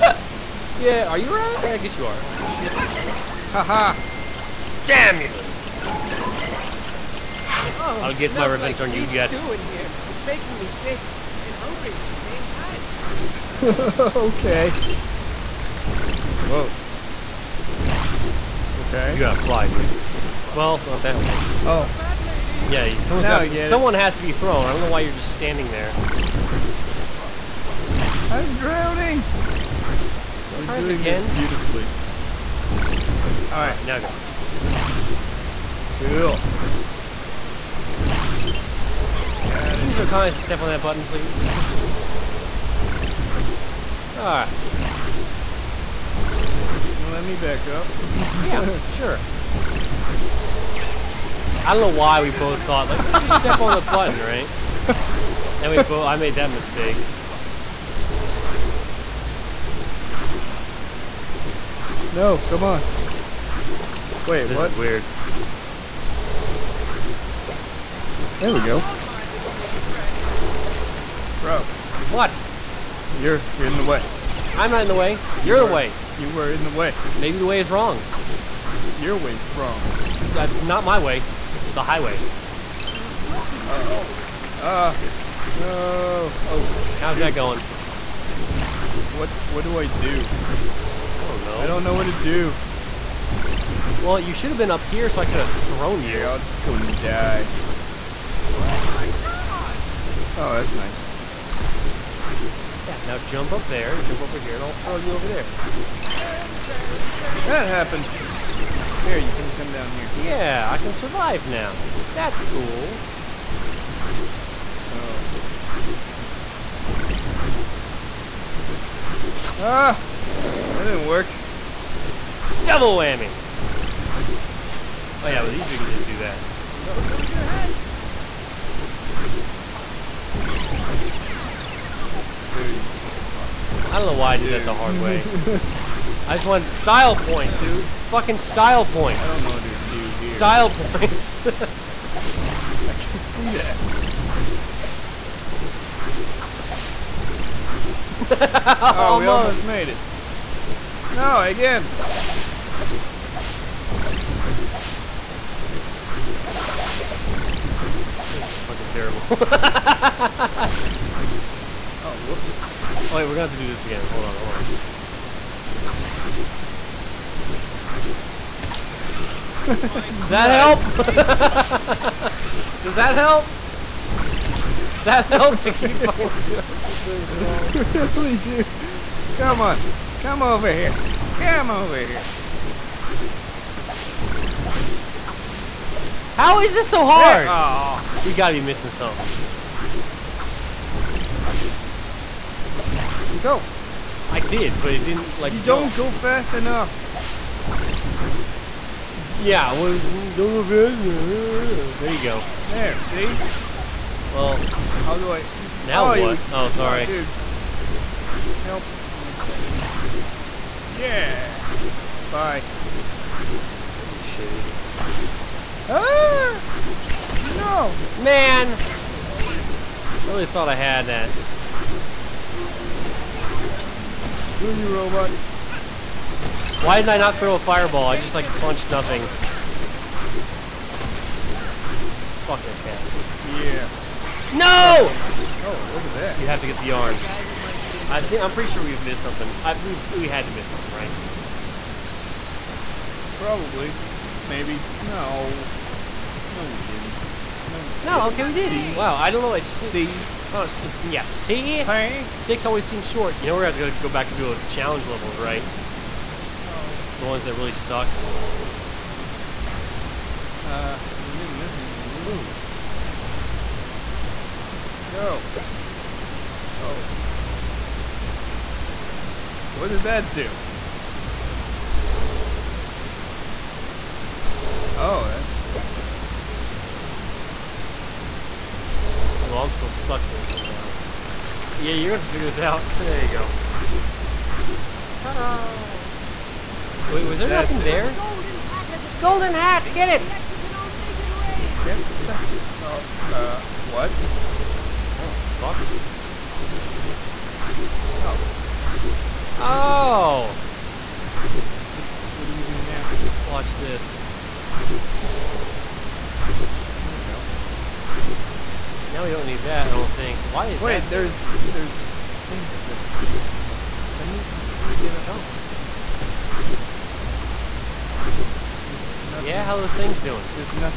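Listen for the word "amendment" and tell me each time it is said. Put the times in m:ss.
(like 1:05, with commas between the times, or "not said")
not said.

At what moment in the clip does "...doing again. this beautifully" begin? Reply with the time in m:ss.
0:30.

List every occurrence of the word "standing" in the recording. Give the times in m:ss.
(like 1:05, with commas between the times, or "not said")
0:25.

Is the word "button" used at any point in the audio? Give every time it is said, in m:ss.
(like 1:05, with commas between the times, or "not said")
0:40, 0:53.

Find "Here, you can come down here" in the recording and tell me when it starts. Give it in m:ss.
1:49.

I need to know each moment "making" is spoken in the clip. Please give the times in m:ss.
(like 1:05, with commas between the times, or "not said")
0:10.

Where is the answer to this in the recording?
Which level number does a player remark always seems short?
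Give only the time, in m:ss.
4:12.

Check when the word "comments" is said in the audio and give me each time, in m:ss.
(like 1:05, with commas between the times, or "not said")
0:40.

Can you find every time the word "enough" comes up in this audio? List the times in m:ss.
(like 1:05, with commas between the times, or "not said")
3:16, 3:21.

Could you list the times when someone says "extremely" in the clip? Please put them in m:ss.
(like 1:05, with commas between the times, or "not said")
not said.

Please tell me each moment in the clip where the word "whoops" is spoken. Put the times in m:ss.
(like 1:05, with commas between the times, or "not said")
2:42.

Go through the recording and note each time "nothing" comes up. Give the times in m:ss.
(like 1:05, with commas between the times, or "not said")
3:48, 4:47, 5:19.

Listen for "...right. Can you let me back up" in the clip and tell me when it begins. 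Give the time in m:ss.
0:44.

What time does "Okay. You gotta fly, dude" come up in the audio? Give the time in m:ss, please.
0:18.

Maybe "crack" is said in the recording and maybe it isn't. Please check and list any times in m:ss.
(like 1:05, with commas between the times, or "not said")
not said.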